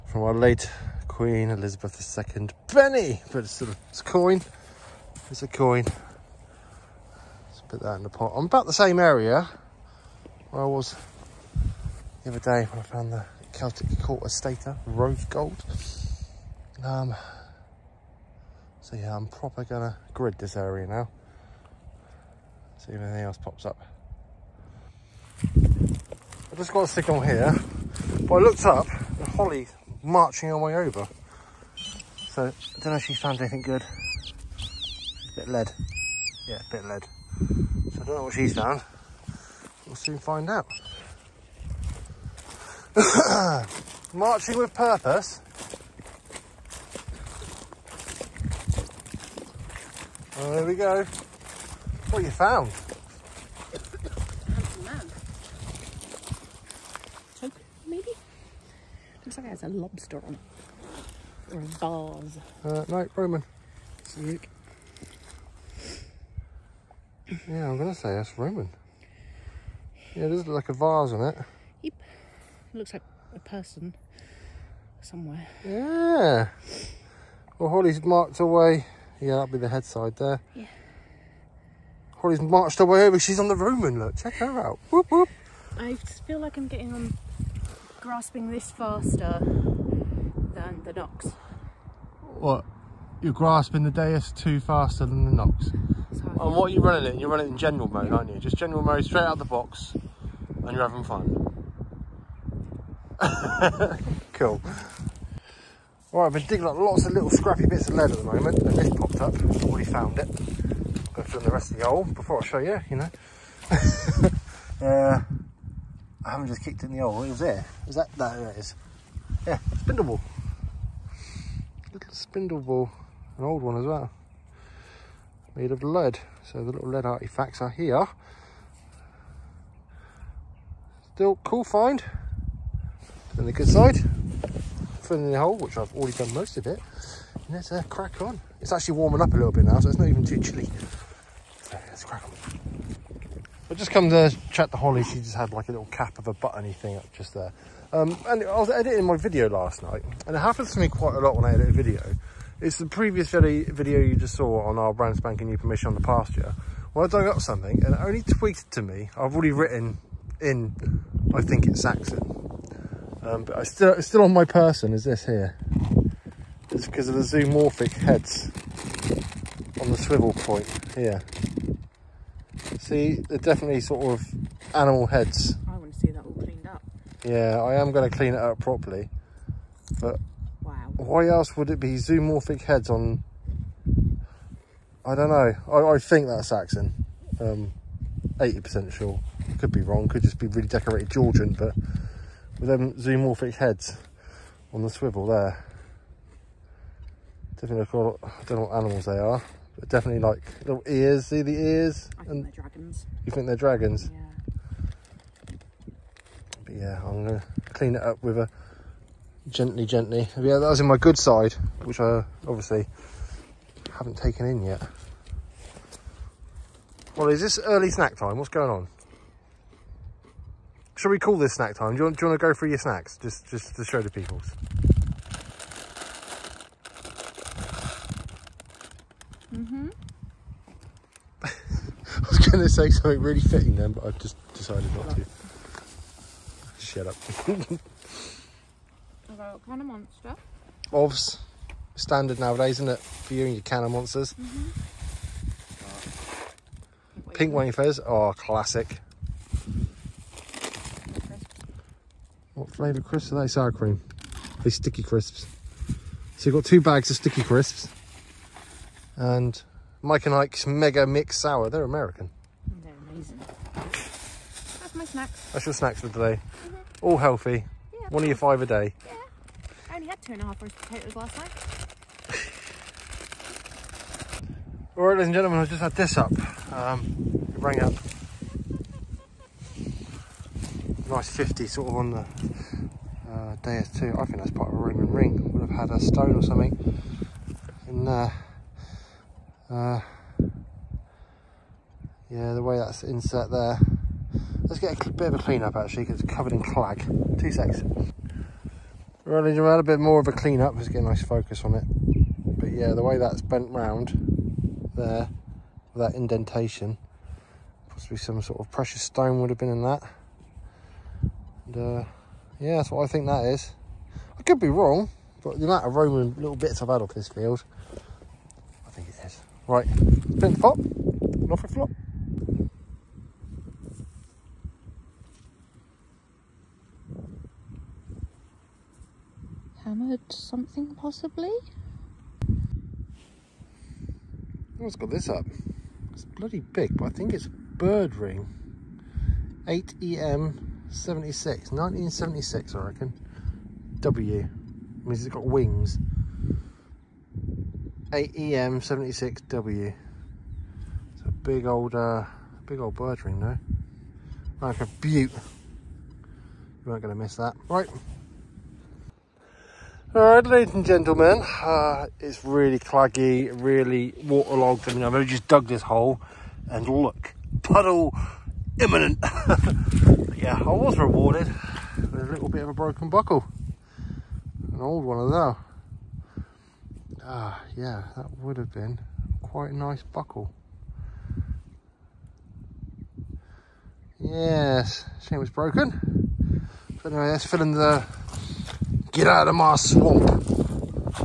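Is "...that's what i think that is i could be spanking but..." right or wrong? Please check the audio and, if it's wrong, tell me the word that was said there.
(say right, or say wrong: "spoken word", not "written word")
wrong: "wrong", not "spanking".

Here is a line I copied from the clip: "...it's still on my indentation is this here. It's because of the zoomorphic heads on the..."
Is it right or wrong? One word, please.
wrong.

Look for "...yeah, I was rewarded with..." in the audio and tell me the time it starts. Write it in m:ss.
6:10.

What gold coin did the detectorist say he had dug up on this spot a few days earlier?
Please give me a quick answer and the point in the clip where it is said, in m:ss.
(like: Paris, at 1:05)
Celtic quarter stater, at 0:13.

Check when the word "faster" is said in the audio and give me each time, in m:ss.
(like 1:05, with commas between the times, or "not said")
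1:28, 1:34.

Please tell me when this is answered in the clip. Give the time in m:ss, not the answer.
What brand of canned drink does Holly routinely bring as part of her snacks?
3:59.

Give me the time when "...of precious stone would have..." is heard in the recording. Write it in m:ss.
5:08.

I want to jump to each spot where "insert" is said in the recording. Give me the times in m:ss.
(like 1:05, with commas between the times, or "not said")
4:53.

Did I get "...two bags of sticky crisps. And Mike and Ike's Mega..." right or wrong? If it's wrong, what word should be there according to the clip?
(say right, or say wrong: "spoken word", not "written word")
right.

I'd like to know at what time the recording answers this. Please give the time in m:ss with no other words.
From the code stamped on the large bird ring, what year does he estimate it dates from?
5:41.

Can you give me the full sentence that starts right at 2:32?
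It's the previous video you just saw on our brand spanking new permission on the pasture.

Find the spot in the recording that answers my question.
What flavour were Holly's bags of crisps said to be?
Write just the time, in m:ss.
4:13.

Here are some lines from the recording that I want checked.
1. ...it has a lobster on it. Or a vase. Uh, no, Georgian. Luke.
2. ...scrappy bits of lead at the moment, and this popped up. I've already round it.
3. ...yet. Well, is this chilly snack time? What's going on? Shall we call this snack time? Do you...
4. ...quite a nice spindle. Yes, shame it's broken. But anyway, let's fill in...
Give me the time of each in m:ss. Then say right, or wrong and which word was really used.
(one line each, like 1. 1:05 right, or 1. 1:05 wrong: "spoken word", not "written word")
1. 0:59 wrong: "Roman", not "Georgian"
2. 1:47 wrong: "found", not "round"
3. 3:34 wrong: "early", not "chilly"
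4. 6:19 wrong: "buckle", not "spindle".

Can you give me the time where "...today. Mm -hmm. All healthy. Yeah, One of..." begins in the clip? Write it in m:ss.
4:26.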